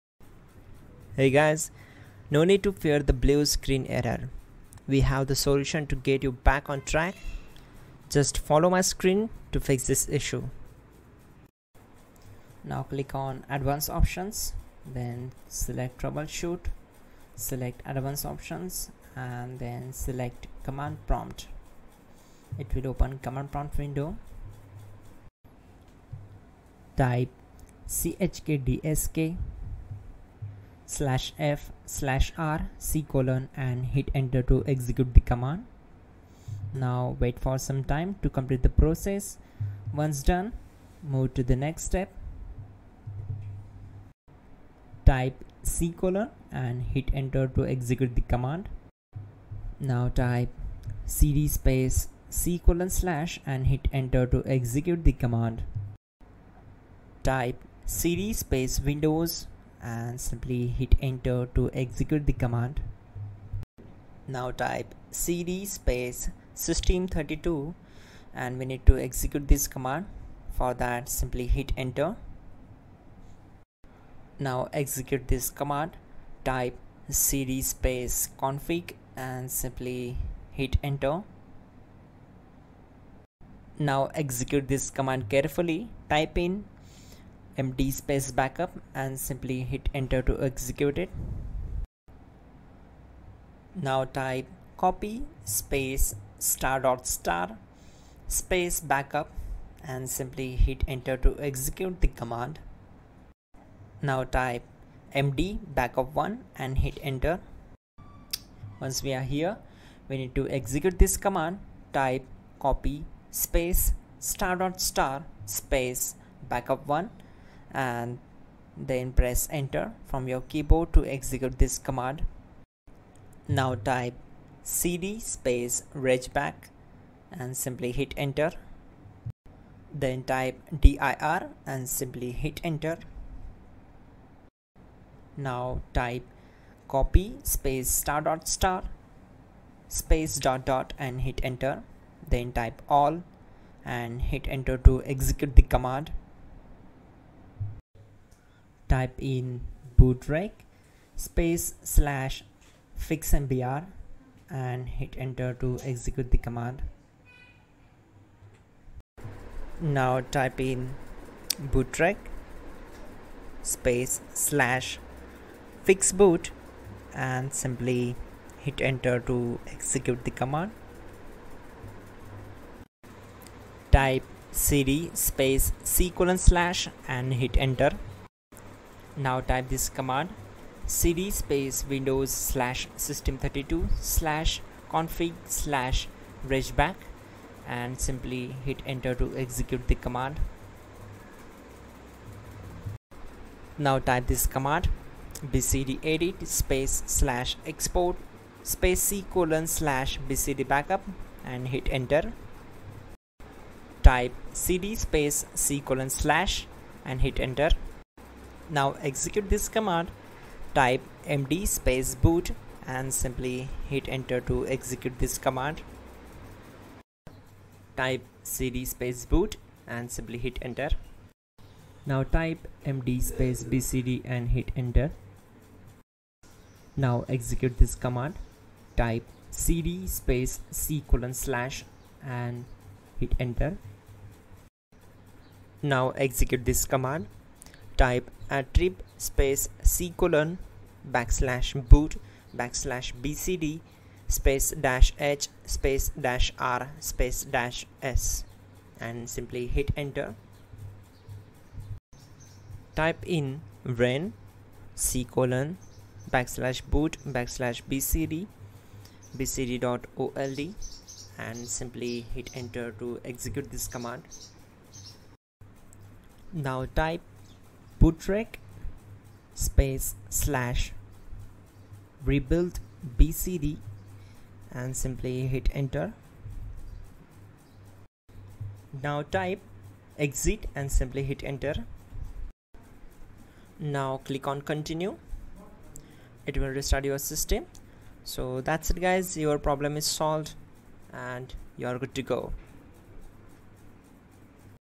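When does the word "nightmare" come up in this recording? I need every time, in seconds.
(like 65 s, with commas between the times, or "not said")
not said.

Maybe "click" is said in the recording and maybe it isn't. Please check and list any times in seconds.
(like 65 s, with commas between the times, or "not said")
12 s, 284 s.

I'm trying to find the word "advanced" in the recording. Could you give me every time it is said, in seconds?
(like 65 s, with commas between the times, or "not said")
13 s, 17 s.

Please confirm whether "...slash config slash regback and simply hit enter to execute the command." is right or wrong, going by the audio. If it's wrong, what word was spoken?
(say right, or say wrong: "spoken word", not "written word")
right.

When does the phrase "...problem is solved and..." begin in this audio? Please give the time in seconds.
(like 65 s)
289 s.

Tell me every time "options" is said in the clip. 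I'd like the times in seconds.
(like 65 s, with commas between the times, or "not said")
13 s, 18 s.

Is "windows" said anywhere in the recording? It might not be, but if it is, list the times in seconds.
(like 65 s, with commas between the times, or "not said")
23 s, 58 s, 181 s.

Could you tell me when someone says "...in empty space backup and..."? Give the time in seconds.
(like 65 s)
86 s.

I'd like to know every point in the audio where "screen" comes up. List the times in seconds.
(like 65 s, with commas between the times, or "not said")
3 s, 8 s.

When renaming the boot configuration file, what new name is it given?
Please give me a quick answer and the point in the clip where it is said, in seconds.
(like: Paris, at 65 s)
bcd.old, at 259 s.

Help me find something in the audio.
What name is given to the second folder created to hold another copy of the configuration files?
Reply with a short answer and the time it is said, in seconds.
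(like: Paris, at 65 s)
backup1, at 105 s.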